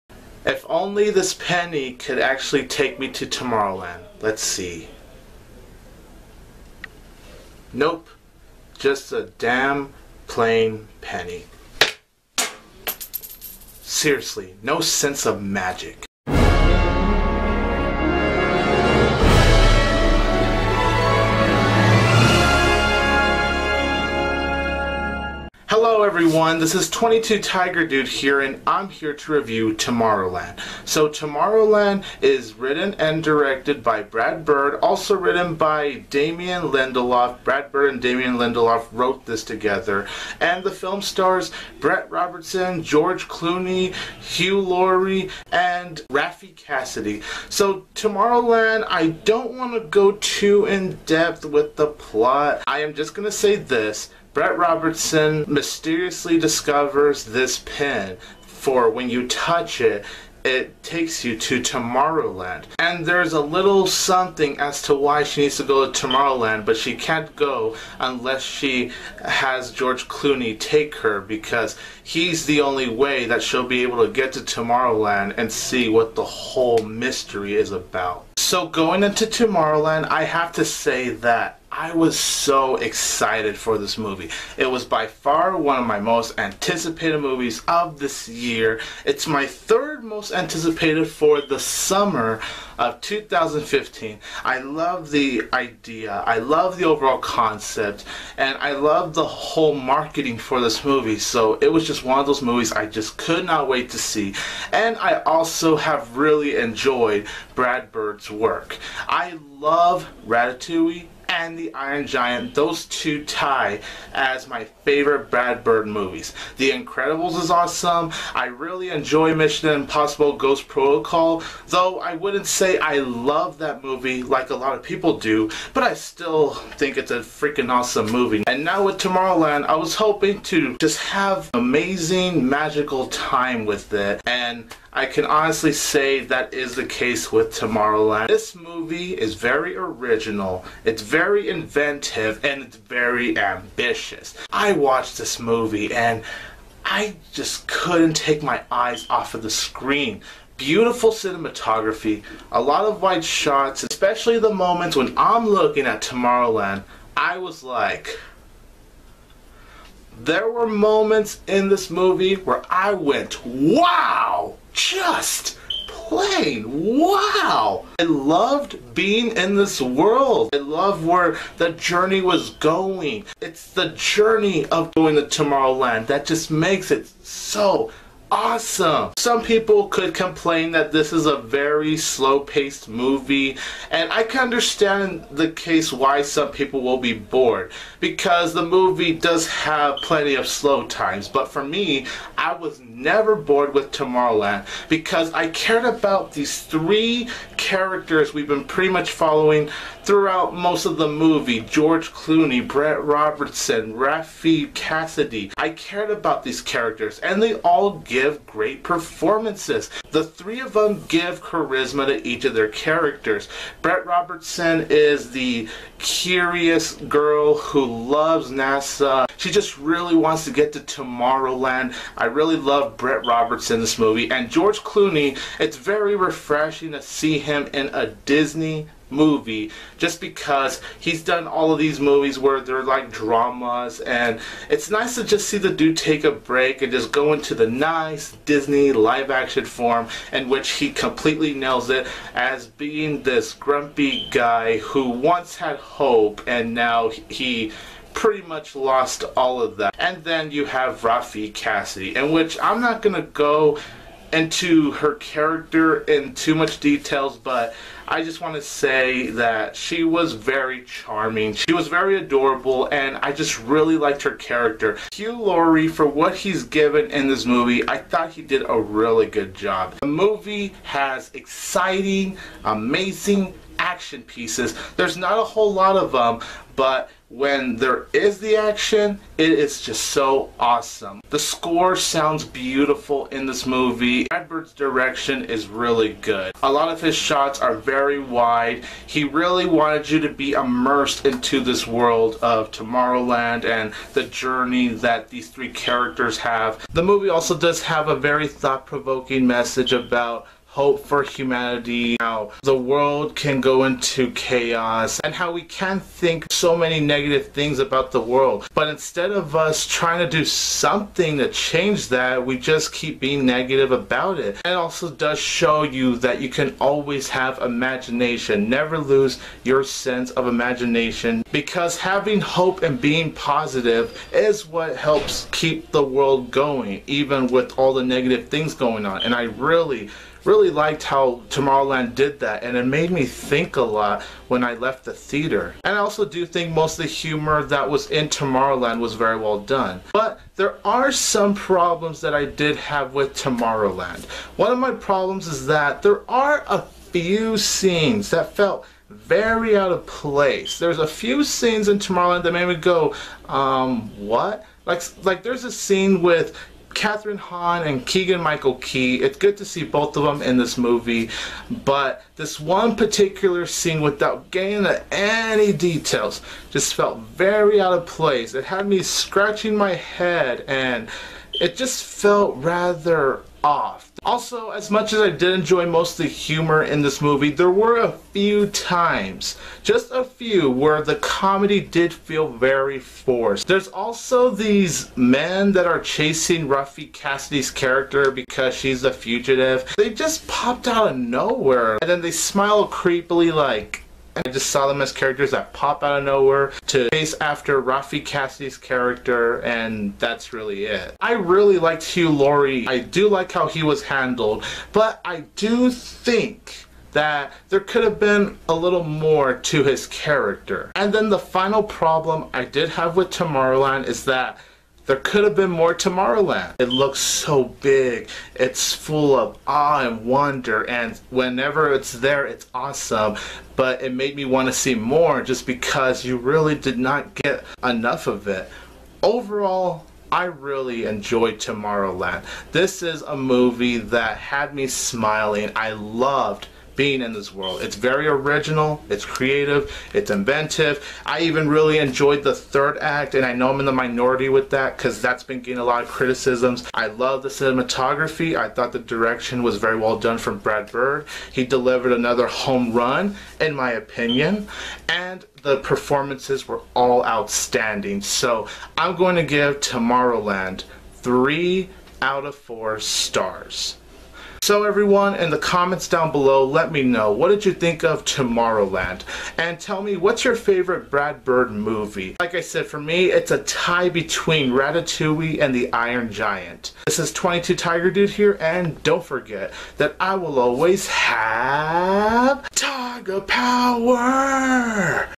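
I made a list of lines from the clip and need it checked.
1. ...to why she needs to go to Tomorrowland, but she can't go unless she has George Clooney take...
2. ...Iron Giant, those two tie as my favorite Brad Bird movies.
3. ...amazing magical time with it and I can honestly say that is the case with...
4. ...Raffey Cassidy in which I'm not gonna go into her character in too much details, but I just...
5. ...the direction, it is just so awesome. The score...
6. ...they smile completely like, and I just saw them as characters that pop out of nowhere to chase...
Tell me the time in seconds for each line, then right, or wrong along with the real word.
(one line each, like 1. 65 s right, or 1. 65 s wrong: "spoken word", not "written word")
1. 64 s right
2. 111 s right
3. 131 s right
4. 251 s right
5. 278 s wrong: "action", not "direction"
6. 392 s wrong: "creepily", not "completely".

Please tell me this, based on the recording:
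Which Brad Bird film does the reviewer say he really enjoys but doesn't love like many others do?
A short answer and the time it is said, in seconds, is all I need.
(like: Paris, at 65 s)
Mission Impossible Ghost Protocol, at 119 s.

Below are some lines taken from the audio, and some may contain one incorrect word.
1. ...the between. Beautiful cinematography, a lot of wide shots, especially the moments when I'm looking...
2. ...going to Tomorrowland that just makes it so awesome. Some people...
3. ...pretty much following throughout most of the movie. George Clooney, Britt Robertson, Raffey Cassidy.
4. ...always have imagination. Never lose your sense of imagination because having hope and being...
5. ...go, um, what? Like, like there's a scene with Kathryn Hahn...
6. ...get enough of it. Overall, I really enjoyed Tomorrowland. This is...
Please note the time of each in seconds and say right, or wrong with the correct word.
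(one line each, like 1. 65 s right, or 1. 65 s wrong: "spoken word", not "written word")
1. 149 s wrong: "screen", not "between"
2. 174 s right
3. 198 s right
4. 316 s right
5. 352 s right
6. 427 s right.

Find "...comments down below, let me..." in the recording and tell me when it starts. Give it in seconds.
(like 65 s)
465 s.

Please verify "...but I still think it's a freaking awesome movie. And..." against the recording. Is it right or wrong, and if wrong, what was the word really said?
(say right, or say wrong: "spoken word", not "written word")
right.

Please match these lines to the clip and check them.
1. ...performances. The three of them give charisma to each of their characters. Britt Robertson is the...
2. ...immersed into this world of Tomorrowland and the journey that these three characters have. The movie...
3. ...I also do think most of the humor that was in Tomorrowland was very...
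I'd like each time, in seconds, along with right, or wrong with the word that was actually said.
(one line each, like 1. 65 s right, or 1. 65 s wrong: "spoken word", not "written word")
1. 208 s right
2. 290 s right
3. 335 s right.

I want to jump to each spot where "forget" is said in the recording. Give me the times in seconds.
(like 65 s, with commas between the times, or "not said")
479 s.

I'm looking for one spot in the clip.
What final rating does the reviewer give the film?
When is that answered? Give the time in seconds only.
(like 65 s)
461 s.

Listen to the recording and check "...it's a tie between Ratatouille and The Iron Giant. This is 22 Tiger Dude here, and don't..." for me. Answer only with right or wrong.
right.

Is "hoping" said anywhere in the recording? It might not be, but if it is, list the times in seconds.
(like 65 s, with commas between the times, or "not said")
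129 s.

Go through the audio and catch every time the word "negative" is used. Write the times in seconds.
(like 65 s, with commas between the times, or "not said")
306 s, 313 s, 328 s.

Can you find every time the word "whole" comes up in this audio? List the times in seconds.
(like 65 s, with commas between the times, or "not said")
76 s, 99 s, 275 s.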